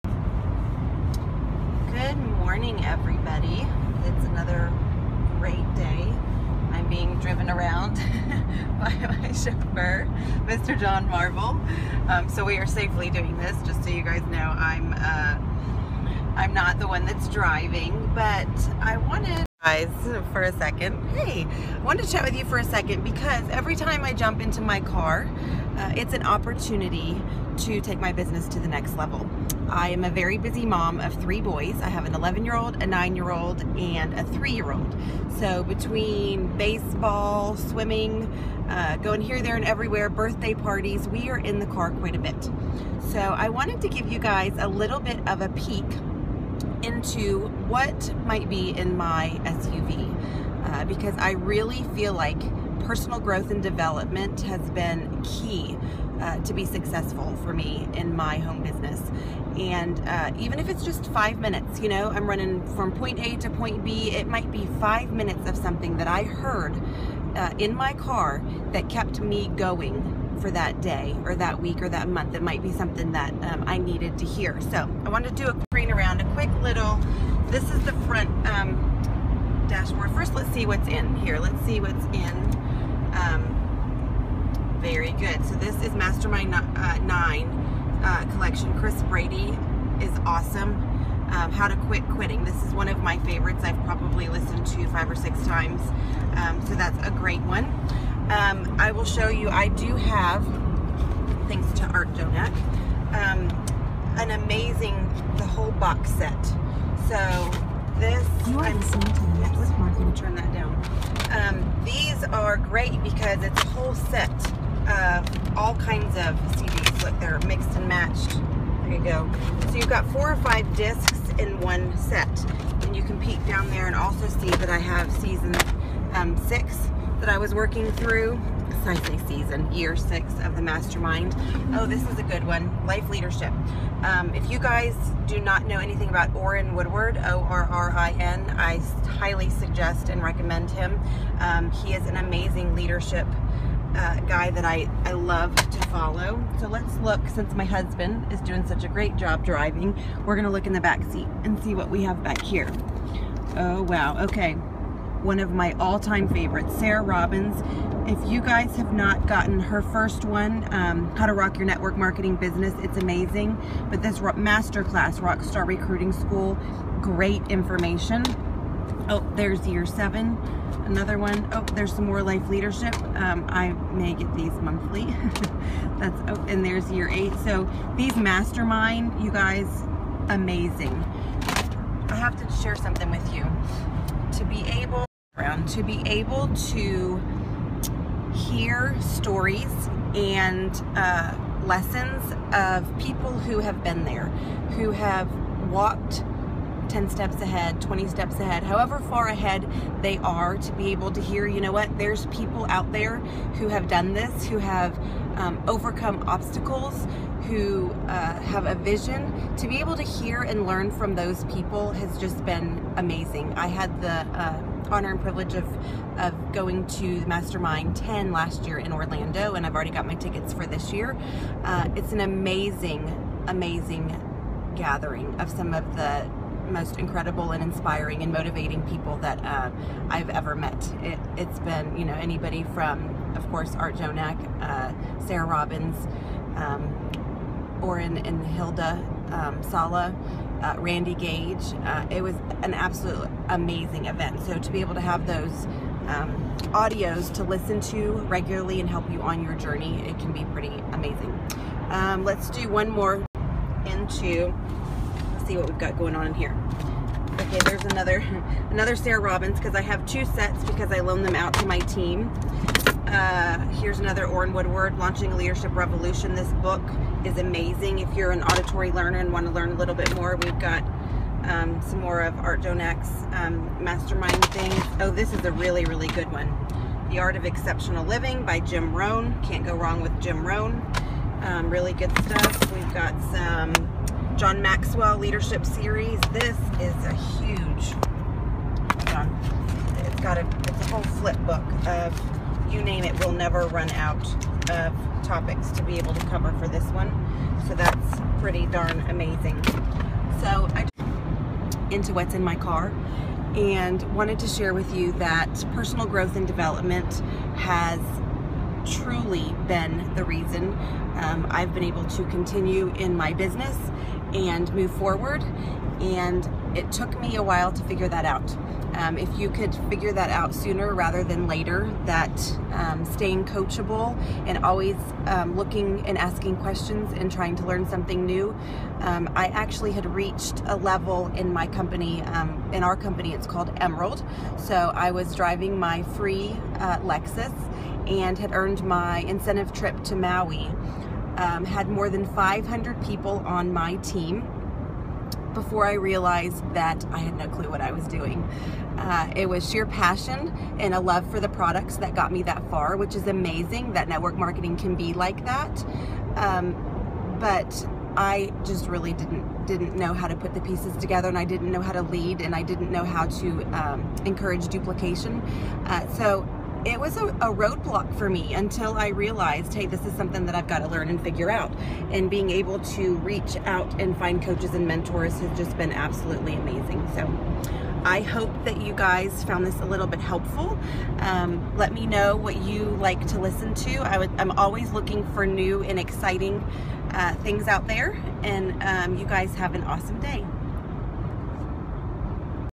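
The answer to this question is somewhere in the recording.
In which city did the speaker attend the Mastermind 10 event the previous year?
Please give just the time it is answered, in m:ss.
3:38.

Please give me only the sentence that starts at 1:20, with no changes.
First, let's see what's in here.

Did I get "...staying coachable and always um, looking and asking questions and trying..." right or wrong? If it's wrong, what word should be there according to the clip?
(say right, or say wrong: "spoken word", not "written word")
right.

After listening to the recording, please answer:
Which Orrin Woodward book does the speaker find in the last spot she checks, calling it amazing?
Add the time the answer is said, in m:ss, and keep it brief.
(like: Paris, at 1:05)
Launching a Leadership Revolution, at 4:24.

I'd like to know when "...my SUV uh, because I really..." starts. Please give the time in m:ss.
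0:48.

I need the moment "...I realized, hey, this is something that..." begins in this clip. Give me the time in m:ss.
6:08.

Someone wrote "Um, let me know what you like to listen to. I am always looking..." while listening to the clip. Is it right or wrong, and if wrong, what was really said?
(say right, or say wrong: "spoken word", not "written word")
right.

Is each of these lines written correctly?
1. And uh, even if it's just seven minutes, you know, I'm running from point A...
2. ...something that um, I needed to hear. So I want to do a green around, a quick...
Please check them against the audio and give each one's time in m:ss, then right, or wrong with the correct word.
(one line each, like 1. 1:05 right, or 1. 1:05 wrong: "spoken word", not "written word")
1. 0:59 wrong: "five", not "seven"
2. 1:12 right.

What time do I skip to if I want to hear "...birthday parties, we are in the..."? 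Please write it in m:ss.
0:40.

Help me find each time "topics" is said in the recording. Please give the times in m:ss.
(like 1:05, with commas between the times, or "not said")
4:55.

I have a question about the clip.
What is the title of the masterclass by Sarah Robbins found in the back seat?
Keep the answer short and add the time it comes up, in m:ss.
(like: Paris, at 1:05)
Rockstar Recruiting School, at 2:45.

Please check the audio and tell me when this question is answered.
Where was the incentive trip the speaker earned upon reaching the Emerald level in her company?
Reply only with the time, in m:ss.
5:40.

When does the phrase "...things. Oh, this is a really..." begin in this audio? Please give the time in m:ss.
4:34.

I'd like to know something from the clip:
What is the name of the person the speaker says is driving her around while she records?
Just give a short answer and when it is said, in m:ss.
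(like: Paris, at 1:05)
John Marble, at 0:10.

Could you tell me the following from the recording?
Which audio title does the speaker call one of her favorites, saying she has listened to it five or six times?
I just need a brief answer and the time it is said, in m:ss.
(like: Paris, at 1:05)
How to Quit Quitting, at 1:31.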